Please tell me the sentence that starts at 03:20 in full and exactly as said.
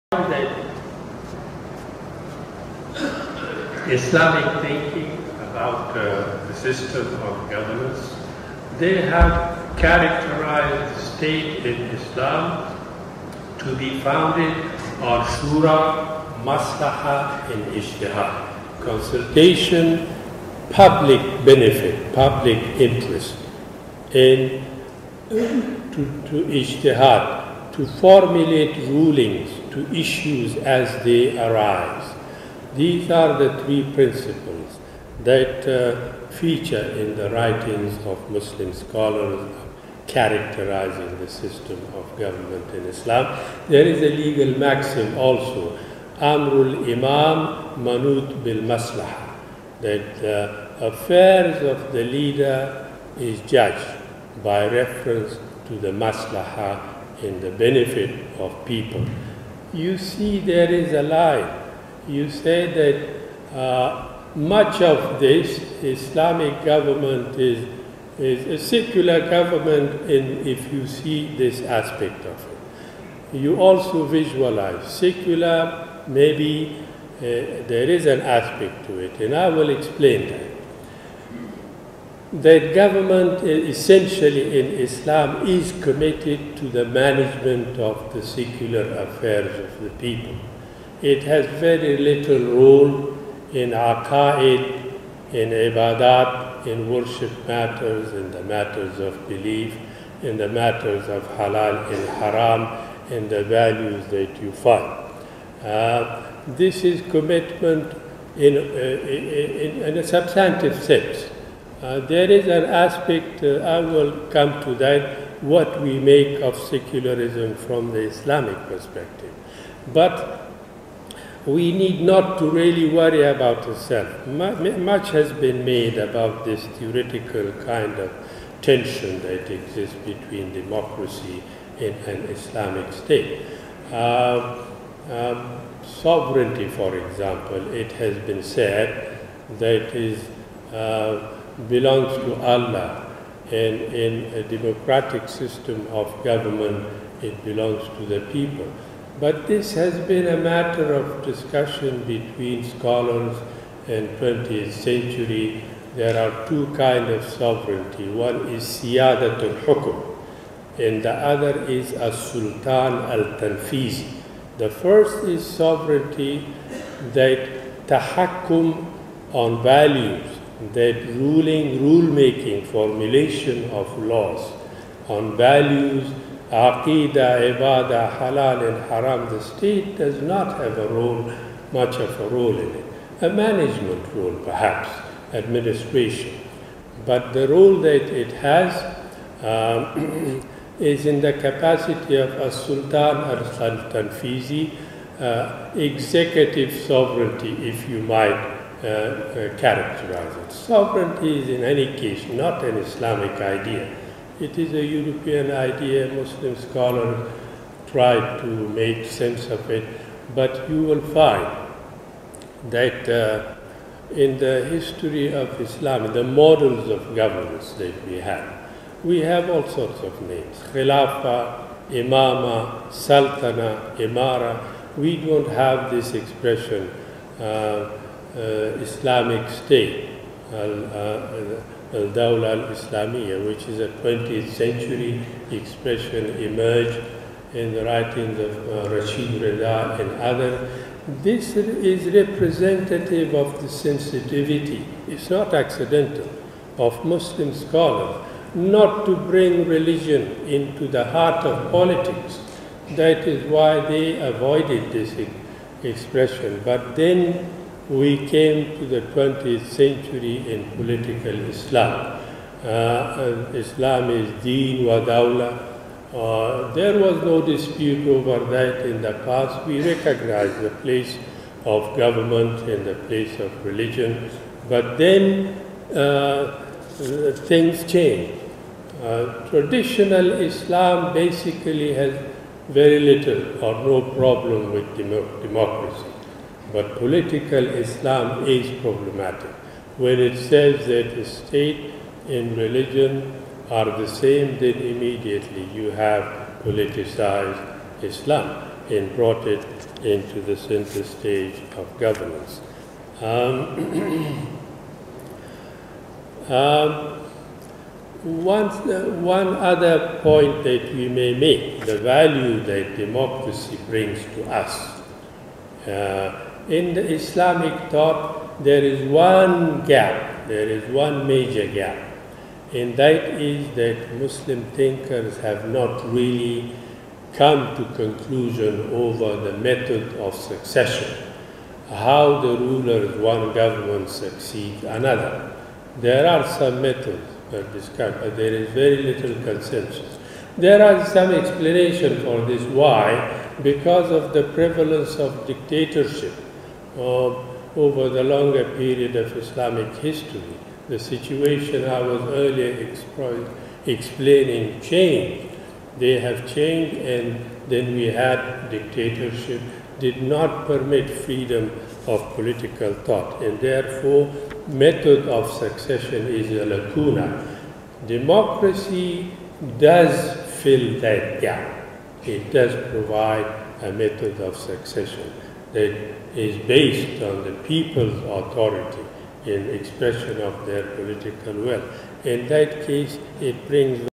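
Sovereignty is, in any case, not an Islamic idea.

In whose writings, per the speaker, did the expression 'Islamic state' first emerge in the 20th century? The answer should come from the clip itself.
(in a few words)
Rashid Rida.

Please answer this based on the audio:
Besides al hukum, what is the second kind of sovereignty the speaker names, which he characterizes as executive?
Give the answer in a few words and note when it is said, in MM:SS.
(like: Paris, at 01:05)
as-sultan al-tanfiz, at 02:41.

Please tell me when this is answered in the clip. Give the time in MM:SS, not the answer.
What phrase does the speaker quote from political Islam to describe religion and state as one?
04:24.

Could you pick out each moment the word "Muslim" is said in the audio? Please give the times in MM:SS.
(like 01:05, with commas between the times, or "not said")
00:38, 03:26, 04:07, 05:24.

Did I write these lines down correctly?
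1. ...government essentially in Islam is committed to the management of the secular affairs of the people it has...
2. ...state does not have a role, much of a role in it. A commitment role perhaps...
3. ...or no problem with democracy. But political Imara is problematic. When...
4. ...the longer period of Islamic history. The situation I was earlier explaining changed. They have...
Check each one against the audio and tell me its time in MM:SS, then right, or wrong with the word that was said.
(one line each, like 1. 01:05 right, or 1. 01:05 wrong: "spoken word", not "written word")
1. 01:22 right
2. 02:59 wrong: "management", not "commitment"
3. 04:43 wrong: "Islam", not "Imara"
4. 05:48 right.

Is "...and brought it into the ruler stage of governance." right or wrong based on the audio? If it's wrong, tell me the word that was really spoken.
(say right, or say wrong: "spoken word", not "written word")
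wrong: "center", not "ruler".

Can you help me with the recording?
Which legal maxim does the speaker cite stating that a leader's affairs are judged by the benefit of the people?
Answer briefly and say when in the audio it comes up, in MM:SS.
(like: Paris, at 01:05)
Amrul Imam Manut bil Maslaha, at 00:46.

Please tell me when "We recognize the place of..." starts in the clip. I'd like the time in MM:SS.
04:29.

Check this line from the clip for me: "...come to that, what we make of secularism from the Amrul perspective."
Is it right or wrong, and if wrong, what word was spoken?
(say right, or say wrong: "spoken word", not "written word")
wrong: "Islamic", not "Amrul".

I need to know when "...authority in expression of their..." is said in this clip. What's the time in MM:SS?
06:18.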